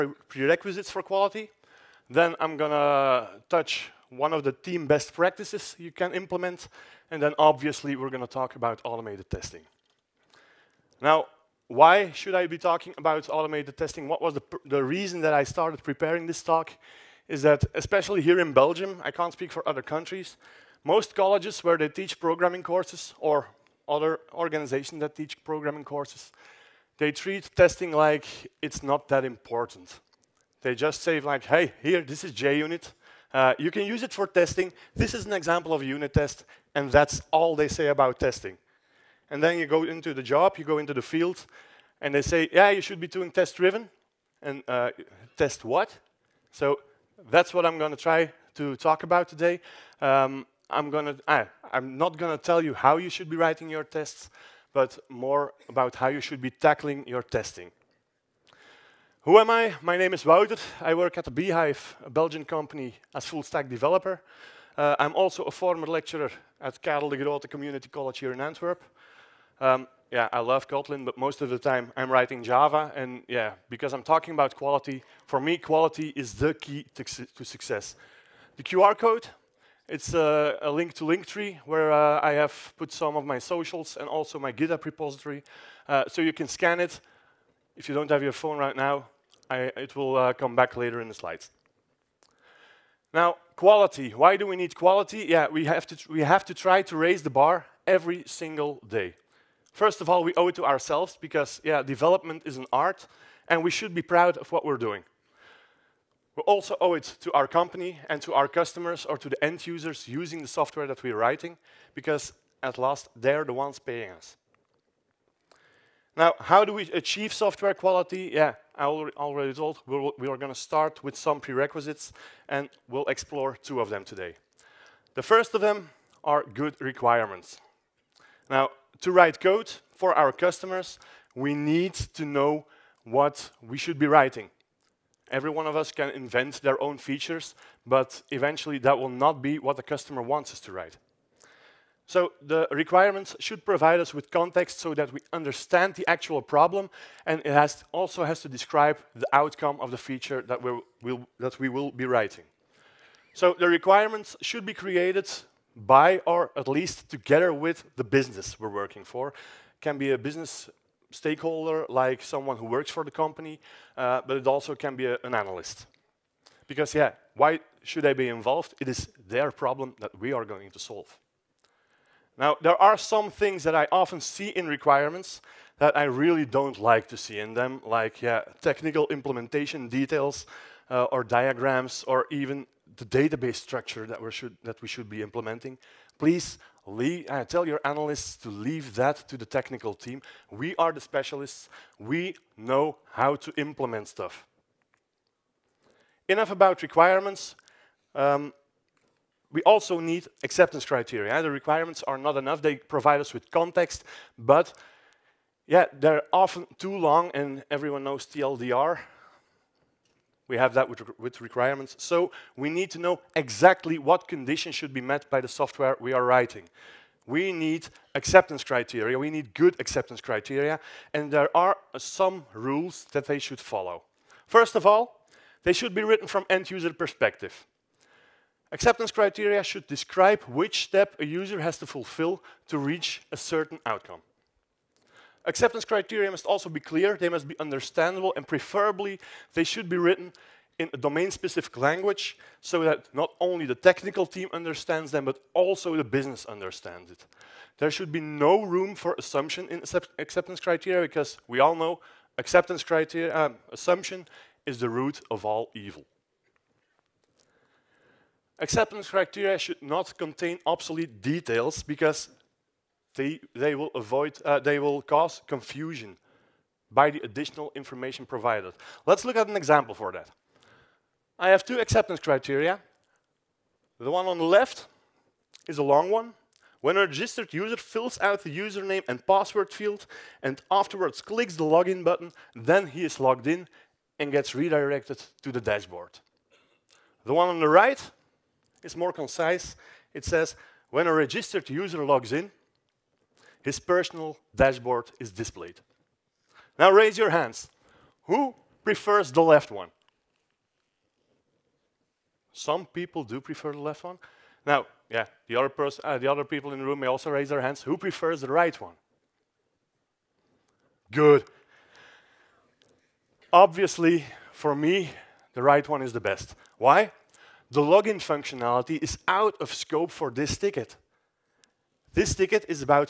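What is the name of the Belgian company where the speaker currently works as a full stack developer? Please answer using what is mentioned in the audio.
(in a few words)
the Beehive.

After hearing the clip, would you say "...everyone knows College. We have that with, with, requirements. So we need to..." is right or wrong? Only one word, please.
wrong.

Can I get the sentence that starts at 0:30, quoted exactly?
They just say like, hey, here, this is JUnit.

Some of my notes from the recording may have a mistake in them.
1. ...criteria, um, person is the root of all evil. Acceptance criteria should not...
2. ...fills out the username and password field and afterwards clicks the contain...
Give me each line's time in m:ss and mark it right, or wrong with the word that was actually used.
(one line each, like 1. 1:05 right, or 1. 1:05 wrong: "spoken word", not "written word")
1. 4:12 wrong: "assumption", not "person"
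2. 4:37 wrong: "login", not "contain".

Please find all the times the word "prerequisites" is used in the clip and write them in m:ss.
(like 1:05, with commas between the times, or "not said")
0:00, 2:01.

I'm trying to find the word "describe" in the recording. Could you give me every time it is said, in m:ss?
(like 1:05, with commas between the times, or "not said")
2:28, 3:49.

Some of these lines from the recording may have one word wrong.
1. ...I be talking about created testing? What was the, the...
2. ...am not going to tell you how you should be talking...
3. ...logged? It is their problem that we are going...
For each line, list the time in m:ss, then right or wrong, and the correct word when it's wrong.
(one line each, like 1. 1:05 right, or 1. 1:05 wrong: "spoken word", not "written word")
1. 0:12 wrong: "automated", not "created"
2. 0:51 wrong: "writing", not "talking"
3. 2:48 wrong: "involved", not "logged".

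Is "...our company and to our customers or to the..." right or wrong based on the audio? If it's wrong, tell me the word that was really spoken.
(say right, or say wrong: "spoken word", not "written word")
right.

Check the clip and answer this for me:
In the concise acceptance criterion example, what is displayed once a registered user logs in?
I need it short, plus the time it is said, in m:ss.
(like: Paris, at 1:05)
his personal dashboard, at 4:53.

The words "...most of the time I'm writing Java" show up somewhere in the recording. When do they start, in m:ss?
1:11.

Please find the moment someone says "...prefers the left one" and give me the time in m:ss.
4:58.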